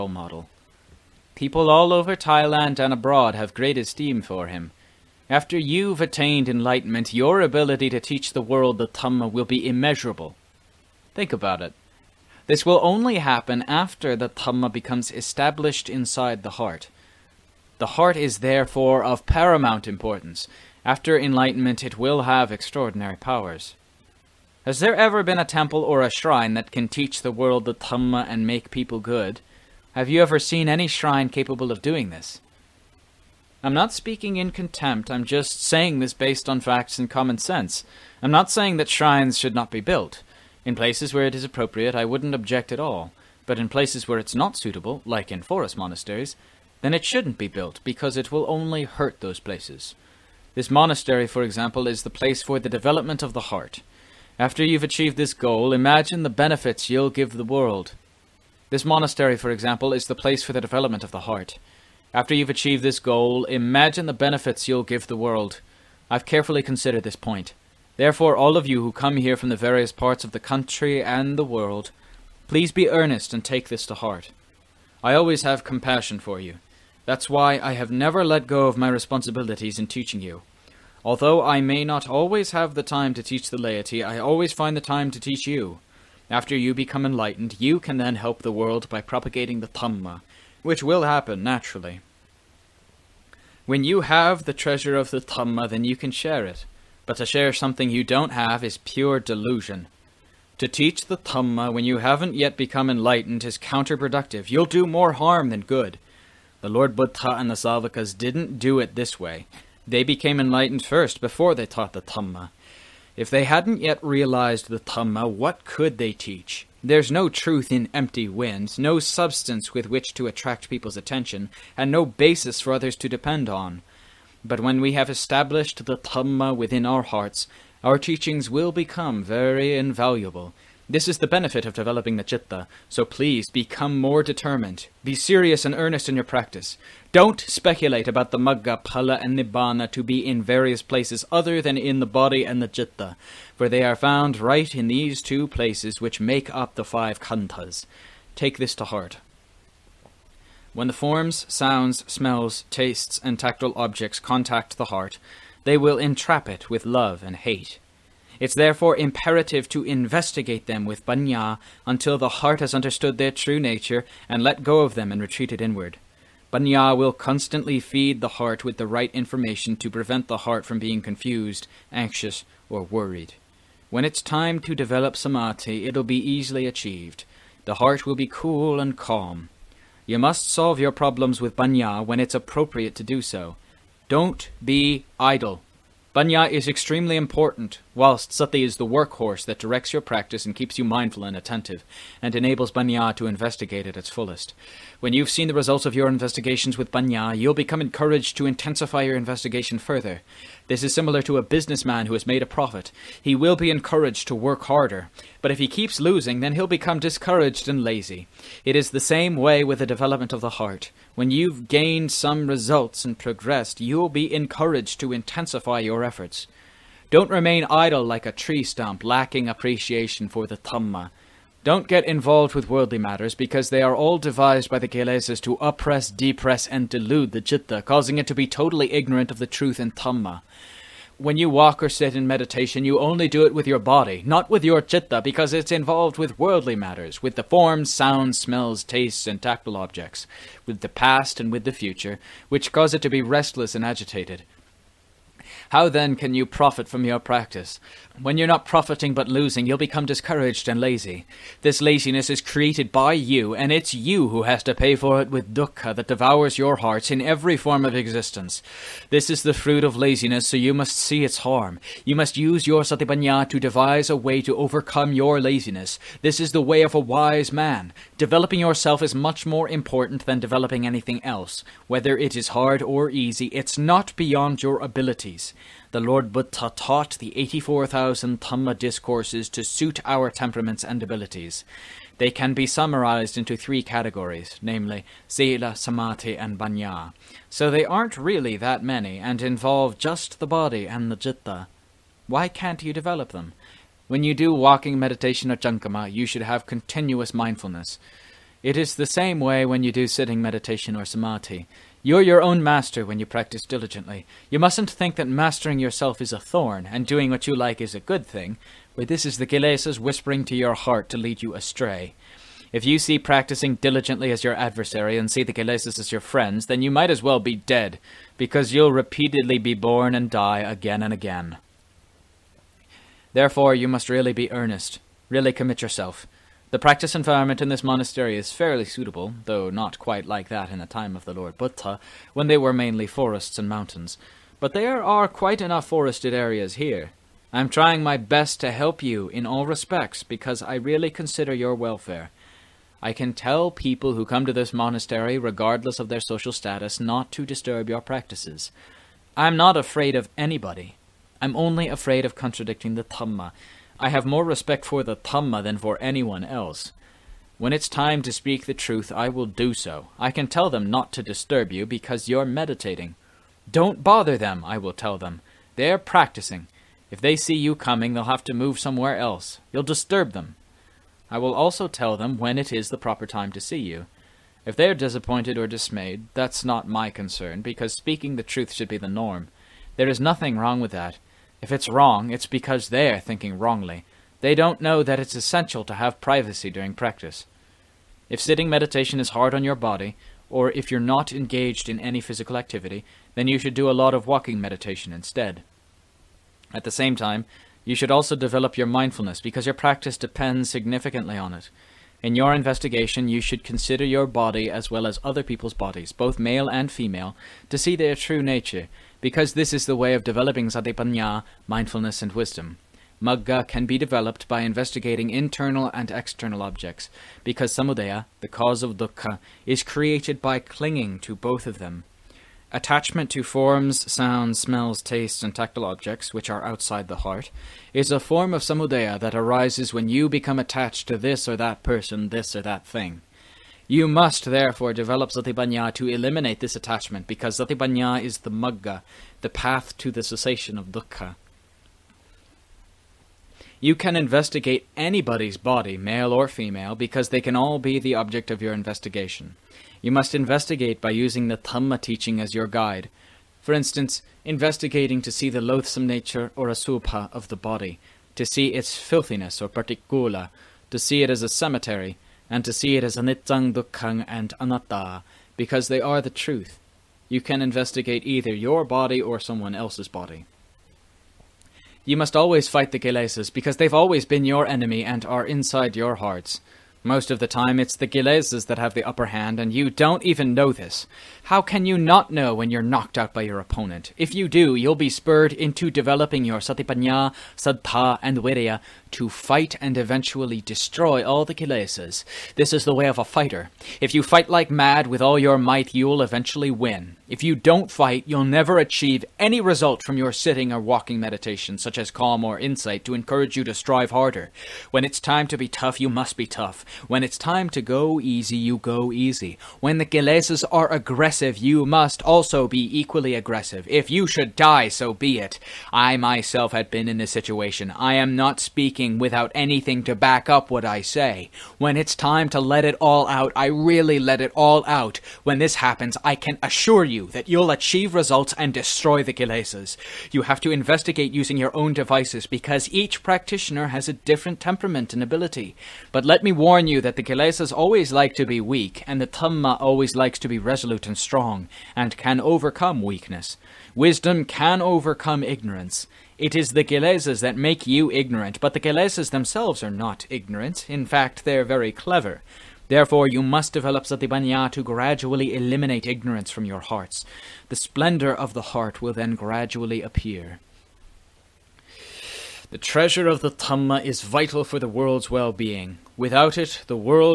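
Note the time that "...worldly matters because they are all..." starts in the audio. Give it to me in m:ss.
3:42.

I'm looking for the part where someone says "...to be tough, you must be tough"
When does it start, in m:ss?
8:25.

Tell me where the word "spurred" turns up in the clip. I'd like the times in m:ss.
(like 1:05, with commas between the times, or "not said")
8:05.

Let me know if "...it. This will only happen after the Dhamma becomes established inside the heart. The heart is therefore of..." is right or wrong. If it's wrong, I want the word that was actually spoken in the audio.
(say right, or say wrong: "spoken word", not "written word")
right.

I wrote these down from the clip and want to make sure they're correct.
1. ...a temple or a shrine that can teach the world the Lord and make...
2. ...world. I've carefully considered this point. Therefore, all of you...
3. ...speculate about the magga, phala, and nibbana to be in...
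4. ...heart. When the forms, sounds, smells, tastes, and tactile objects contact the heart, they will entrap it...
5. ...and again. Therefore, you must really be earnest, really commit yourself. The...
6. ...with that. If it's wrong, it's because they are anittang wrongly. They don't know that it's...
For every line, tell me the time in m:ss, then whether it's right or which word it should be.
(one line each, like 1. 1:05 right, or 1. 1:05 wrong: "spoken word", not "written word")
1. 0:25 wrong: "Dhamma", not "Lord"
2. 1:05 right
3. 2:17 right
4. 2:28 right
5. 5:21 right
6. 6:20 wrong: "thinking", not "anittang".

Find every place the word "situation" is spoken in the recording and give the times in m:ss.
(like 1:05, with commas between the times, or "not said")
8:37.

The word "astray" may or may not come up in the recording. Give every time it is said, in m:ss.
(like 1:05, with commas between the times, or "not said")
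5:11.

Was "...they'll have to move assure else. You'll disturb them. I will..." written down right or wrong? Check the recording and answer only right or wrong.
wrong.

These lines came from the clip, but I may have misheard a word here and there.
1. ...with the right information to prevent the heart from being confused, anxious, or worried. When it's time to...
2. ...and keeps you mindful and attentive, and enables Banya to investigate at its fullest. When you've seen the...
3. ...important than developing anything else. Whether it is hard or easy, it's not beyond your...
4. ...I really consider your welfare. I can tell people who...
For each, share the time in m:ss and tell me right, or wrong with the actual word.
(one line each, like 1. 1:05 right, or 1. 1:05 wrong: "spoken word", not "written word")
1. 2:48 right
2. 3:10 right
3. 4:29 right
4. 5:40 right.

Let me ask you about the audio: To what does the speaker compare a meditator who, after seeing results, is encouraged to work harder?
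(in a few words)
a businessman.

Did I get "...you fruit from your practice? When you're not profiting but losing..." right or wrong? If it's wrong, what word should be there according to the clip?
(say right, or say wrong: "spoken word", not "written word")
wrong: "profit", not "fruit".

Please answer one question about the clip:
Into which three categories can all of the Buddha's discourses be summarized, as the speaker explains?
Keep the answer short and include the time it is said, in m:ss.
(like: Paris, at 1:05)
Sila, Samadhi, and Banya, at 4:45.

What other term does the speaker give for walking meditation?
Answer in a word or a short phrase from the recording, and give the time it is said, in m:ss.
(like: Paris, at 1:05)
Chankama, at 4:55.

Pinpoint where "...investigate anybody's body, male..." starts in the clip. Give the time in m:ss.
7:24.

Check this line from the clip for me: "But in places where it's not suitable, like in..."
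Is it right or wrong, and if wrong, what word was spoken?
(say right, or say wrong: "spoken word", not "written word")
right.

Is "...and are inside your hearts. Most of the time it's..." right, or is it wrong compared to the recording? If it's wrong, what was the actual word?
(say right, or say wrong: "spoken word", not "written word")
right.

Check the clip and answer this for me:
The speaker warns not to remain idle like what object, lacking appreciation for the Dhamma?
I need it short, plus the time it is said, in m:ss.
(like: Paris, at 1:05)
a tree stump, at 3:38.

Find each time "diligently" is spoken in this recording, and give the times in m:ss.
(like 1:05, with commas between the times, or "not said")
5:03, 5:13.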